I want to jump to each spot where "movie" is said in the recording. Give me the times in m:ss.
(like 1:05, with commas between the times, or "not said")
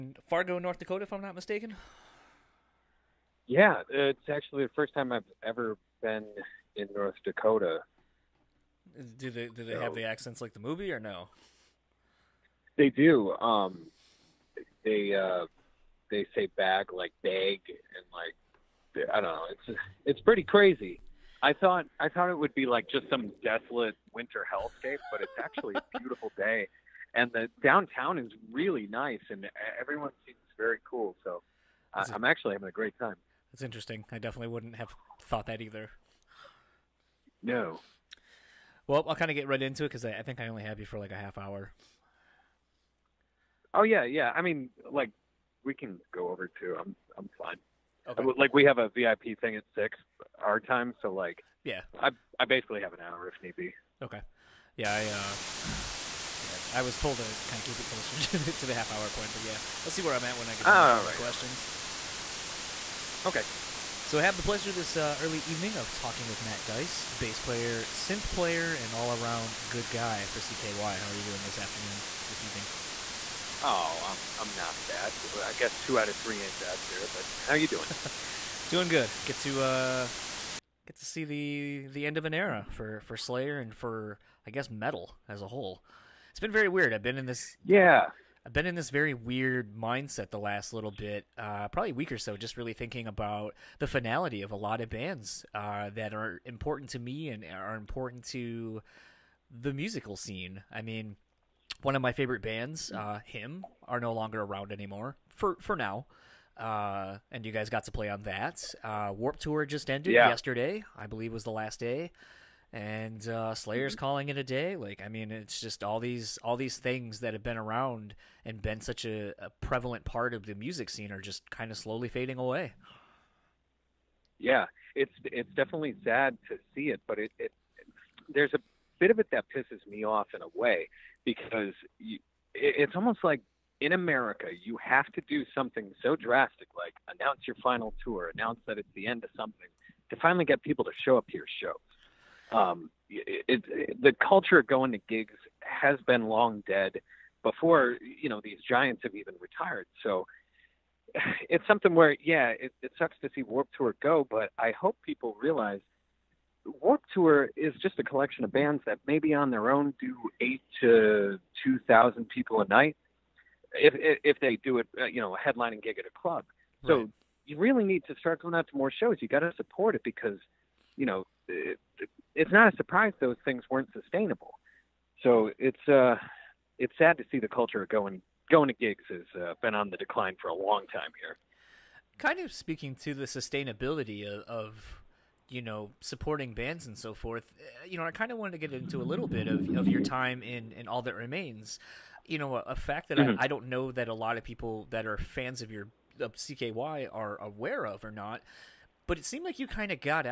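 0:10.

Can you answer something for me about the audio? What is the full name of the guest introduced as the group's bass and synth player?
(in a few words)
Matt Dice.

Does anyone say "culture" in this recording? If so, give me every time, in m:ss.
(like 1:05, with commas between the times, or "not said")
2:24, 2:57.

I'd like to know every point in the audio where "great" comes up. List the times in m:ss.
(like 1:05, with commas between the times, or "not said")
0:32.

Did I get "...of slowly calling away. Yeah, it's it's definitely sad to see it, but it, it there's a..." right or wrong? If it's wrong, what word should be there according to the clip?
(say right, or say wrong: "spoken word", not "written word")
wrong: "fading", not "calling".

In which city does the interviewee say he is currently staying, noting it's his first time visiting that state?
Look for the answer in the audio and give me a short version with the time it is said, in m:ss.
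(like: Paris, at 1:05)
Fargo, at 0:00.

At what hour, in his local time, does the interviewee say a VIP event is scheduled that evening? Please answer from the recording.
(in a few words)
6.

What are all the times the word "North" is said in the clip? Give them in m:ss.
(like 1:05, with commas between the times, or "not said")
0:00, 0:06.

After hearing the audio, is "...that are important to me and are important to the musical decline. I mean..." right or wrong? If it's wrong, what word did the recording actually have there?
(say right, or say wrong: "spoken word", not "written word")
wrong: "scene", not "decline".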